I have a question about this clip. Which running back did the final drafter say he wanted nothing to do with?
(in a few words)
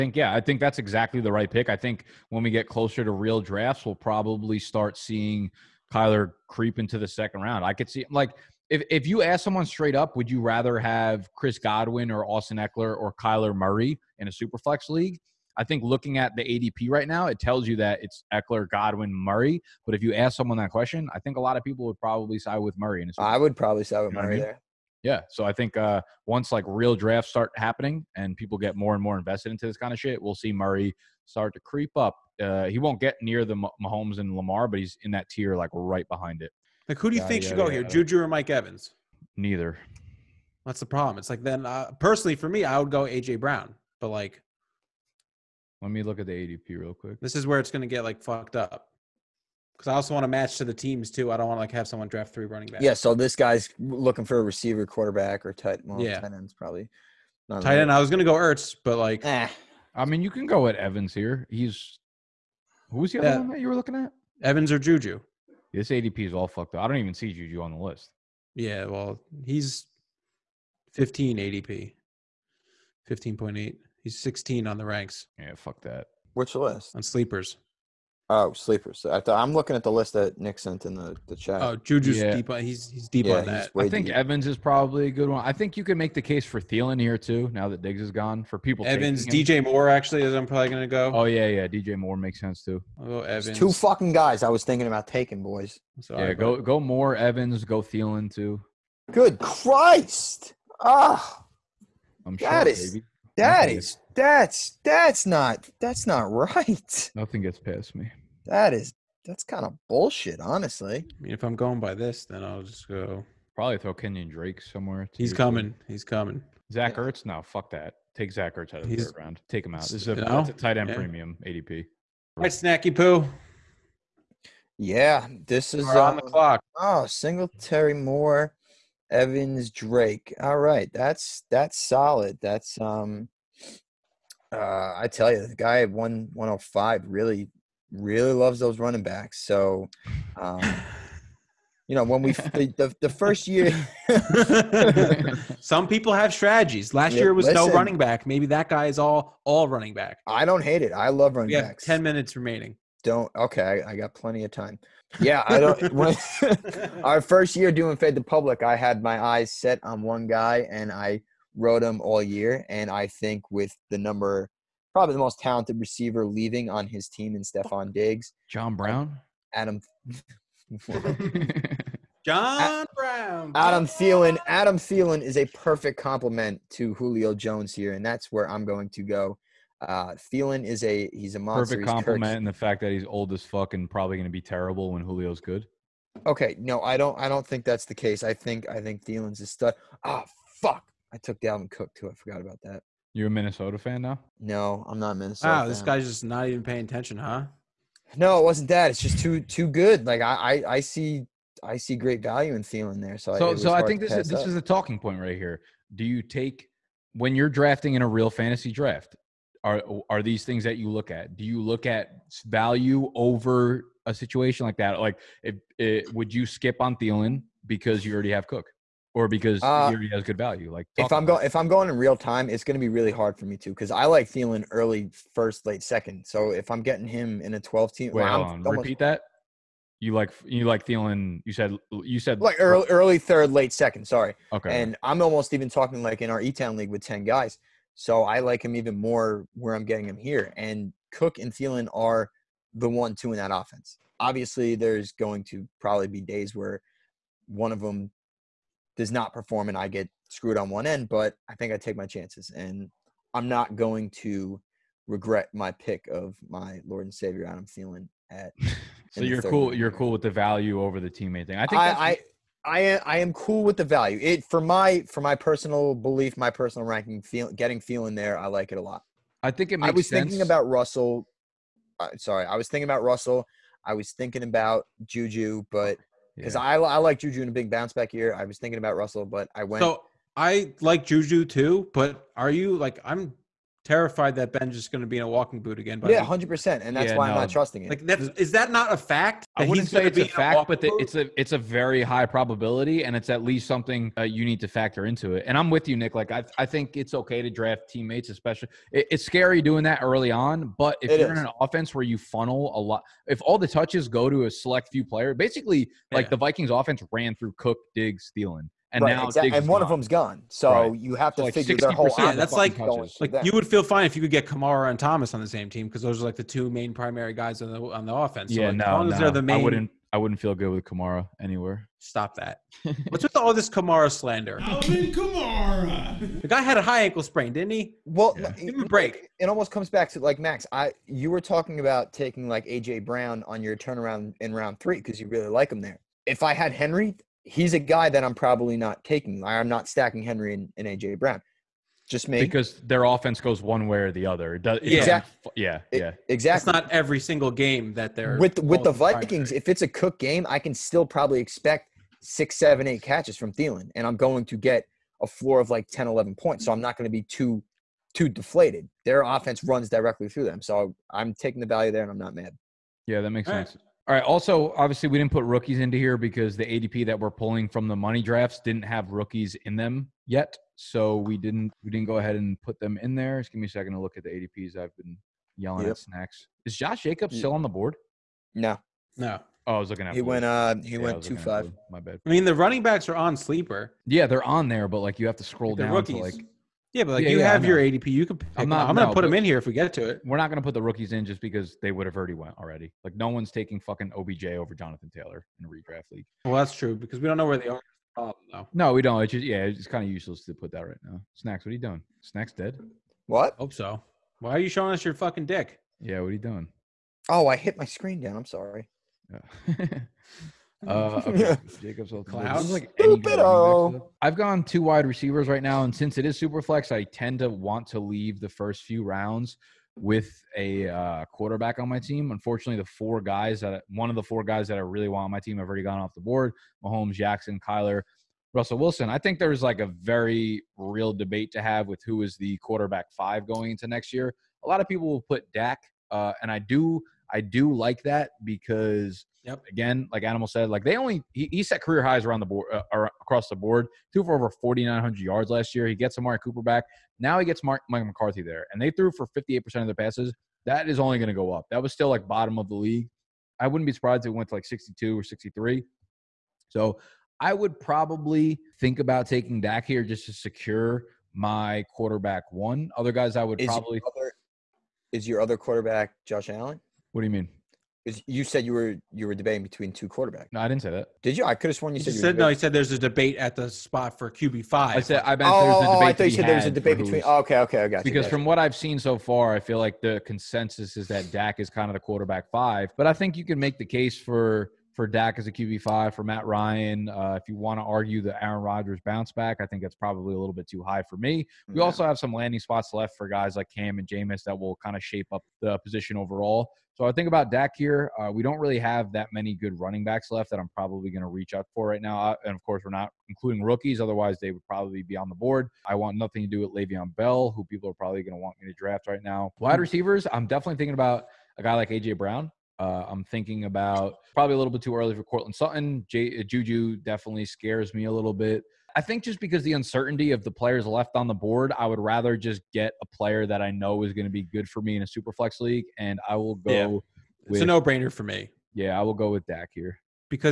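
Le'Veon Bell.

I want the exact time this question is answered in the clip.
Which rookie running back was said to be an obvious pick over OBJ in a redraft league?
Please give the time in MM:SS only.
06:34.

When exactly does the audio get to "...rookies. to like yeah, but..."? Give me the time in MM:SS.
06:25.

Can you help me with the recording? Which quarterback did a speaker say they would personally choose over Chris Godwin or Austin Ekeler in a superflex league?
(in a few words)
Kyler Murray.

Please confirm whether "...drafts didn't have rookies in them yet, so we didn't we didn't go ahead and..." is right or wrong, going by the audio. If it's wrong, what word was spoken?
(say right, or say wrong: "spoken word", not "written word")
right.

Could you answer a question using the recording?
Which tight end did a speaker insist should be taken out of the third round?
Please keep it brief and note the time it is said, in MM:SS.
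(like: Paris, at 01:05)
Zach Ertz, at 01:58.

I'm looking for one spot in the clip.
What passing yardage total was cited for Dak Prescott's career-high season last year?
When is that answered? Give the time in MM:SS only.
07:24.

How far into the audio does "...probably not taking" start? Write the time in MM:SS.
05:38.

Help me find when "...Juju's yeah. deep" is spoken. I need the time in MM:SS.
01:21.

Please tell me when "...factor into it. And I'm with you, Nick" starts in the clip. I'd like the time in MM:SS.
04:54.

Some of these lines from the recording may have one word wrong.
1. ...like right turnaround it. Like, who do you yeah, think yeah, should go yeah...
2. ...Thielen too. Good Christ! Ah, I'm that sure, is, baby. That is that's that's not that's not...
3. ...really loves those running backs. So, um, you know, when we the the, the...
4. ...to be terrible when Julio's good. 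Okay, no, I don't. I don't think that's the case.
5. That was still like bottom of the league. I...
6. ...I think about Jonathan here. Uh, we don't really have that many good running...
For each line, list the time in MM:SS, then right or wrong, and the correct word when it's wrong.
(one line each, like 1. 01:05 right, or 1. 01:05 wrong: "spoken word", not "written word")
1. 00:35 wrong: "behind", not "turnaround"
2. 01:37 right
3. 02:17 right
4. 03:04 right
5. 07:31 right
6. 08:17 wrong: "Dak", not "Jonathan".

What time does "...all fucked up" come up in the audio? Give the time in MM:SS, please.
01:06.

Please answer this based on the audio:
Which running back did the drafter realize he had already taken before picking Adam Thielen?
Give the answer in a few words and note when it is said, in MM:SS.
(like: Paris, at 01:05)
Dalvin Cook, at 03:11.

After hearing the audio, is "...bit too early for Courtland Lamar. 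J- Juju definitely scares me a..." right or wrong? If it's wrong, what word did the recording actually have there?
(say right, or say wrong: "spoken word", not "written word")
wrong: "Sutton", not "Lamar".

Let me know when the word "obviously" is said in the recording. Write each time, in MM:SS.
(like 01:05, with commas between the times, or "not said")
04:04, 06:04.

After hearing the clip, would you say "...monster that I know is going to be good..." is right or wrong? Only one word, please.
wrong.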